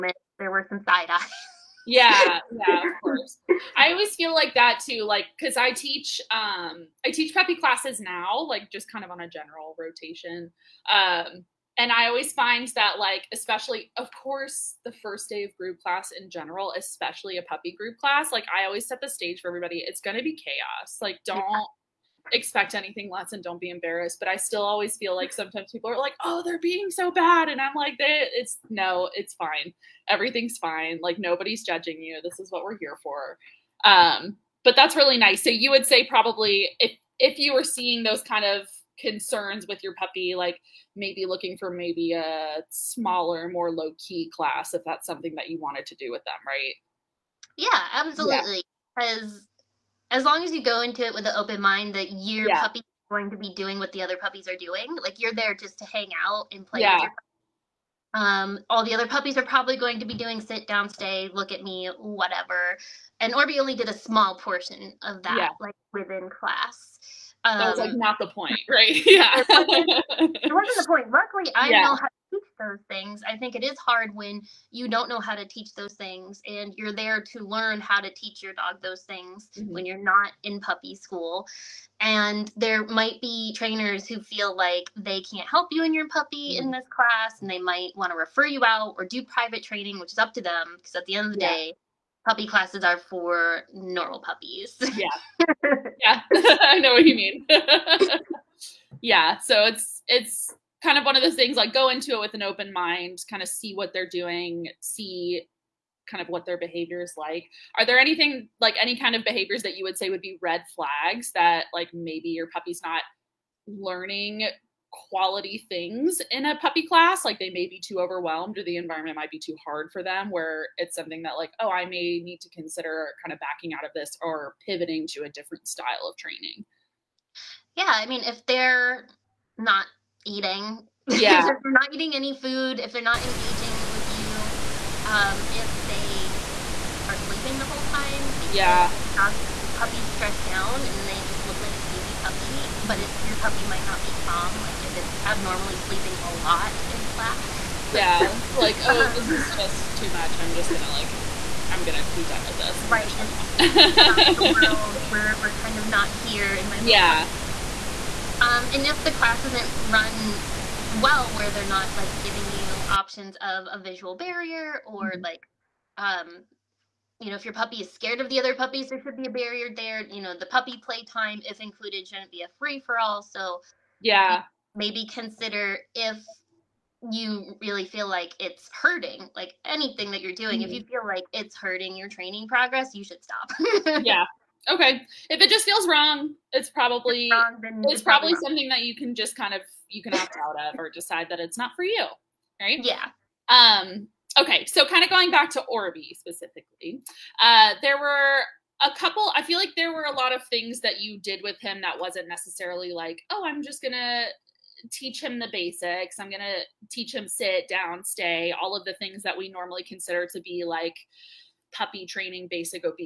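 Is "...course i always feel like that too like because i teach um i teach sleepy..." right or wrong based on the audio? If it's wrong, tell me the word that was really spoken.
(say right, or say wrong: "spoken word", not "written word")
wrong: "preppy", not "sleepy".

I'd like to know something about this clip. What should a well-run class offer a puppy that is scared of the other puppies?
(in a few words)
a visual barrier.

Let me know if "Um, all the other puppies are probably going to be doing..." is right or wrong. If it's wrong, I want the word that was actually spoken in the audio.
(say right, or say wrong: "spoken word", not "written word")
right.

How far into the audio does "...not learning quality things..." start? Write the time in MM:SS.
01:52.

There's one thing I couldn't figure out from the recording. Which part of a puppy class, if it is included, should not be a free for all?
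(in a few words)
puppy playtime.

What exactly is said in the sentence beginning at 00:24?
But I still always feel like sometimes people are like, oh, they're being so bad.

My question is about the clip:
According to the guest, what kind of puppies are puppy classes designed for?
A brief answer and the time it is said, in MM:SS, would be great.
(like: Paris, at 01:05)
normal puppies, at 01:33.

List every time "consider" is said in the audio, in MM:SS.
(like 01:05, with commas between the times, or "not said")
02:02, 02:55, 03:29.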